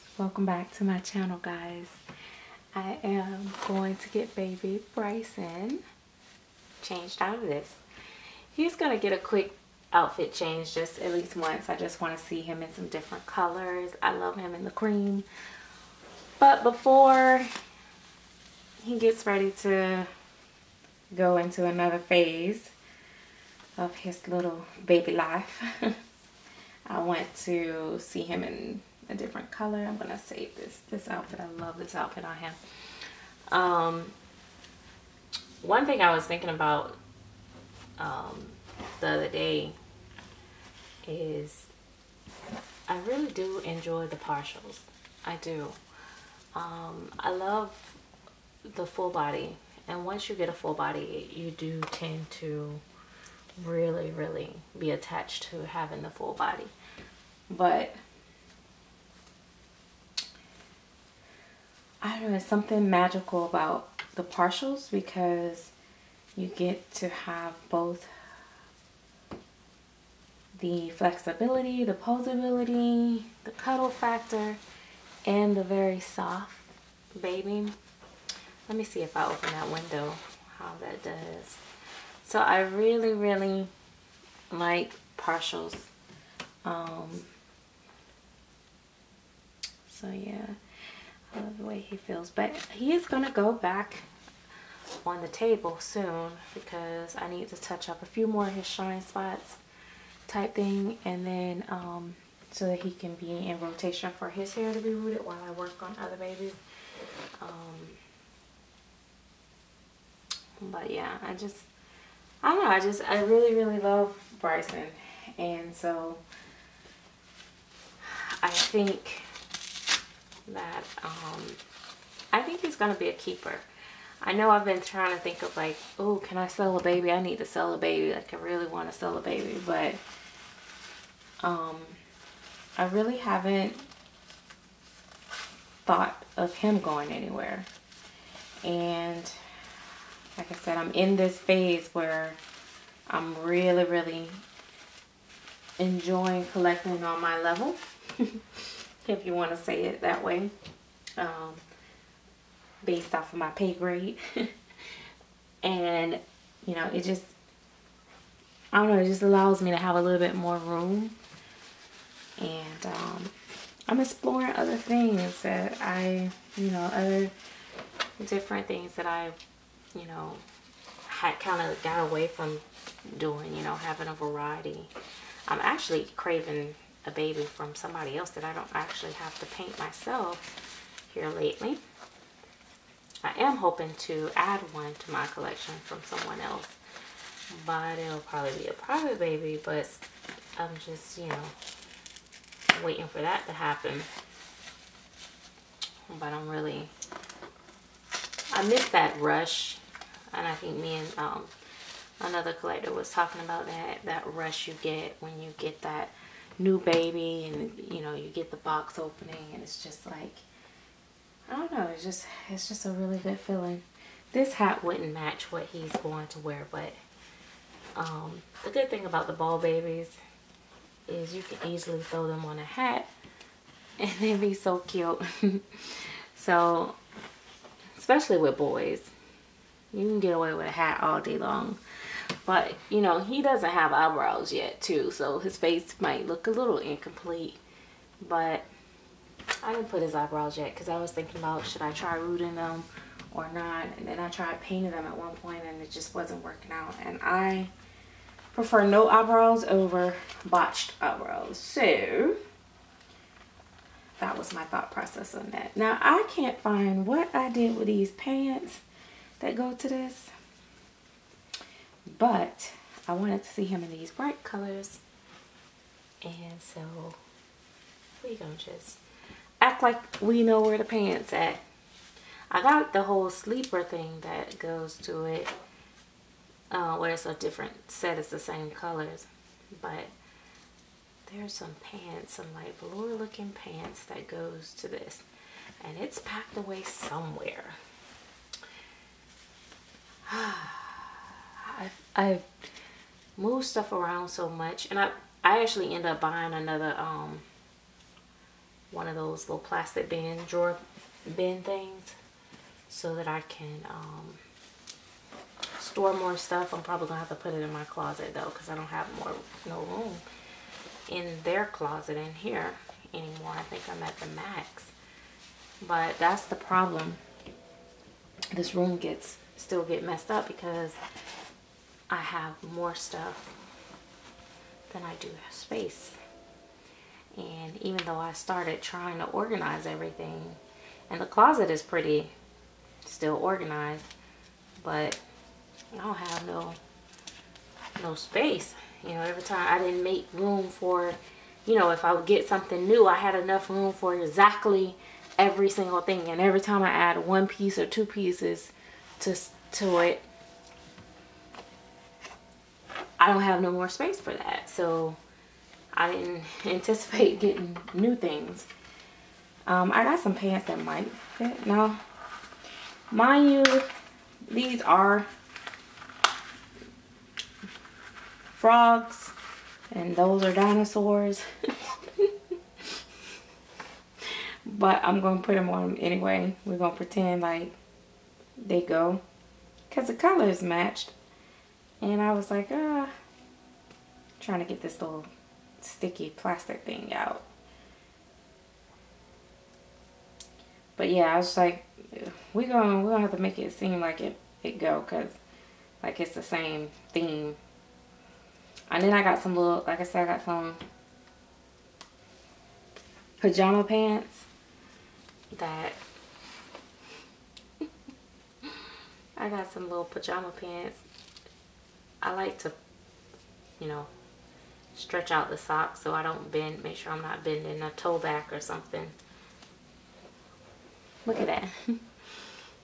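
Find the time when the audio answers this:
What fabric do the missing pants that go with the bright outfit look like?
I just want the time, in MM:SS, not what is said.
04:42.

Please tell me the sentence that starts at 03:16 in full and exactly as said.
But I'm really, I miss that rush.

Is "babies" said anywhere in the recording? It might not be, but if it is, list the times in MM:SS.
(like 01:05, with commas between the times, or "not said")
01:46, 03:39.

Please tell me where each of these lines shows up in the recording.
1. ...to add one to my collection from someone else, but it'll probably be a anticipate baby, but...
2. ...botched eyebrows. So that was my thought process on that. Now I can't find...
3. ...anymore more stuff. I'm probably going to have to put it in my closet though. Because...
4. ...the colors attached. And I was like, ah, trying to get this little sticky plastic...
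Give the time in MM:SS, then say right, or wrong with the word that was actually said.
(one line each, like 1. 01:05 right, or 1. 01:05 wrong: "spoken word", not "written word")
1. 03:03 wrong: "private", not "anticipate"
2. 04:10 right
3. 05:05 wrong: "store", not "anymore"
4. 06:20 wrong: "matched", not "attached".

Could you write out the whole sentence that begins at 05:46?
And every time I add one piece or two pieces to to it, I don't have no more space for that.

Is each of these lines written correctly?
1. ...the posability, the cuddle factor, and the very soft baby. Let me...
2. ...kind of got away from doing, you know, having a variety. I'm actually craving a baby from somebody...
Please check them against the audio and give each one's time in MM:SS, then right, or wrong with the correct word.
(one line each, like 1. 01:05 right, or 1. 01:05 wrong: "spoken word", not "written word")
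1. 01:11 right
2. 02:51 right.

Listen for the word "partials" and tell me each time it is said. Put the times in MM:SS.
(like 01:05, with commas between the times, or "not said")
00:44, 01:04, 01:25.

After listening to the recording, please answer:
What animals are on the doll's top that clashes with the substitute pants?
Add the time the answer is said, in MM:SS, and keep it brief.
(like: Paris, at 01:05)
dinosaurs, at 06:10.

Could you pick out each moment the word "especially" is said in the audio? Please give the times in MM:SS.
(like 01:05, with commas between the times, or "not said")
03:47.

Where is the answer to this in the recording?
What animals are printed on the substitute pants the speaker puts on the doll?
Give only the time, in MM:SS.
06:08.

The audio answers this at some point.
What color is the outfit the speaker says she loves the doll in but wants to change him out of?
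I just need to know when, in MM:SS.
00:14.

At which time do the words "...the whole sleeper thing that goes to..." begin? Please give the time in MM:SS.
04:32.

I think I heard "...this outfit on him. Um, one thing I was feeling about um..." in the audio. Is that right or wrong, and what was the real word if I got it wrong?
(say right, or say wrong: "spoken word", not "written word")
wrong: "thinking", not "feeling".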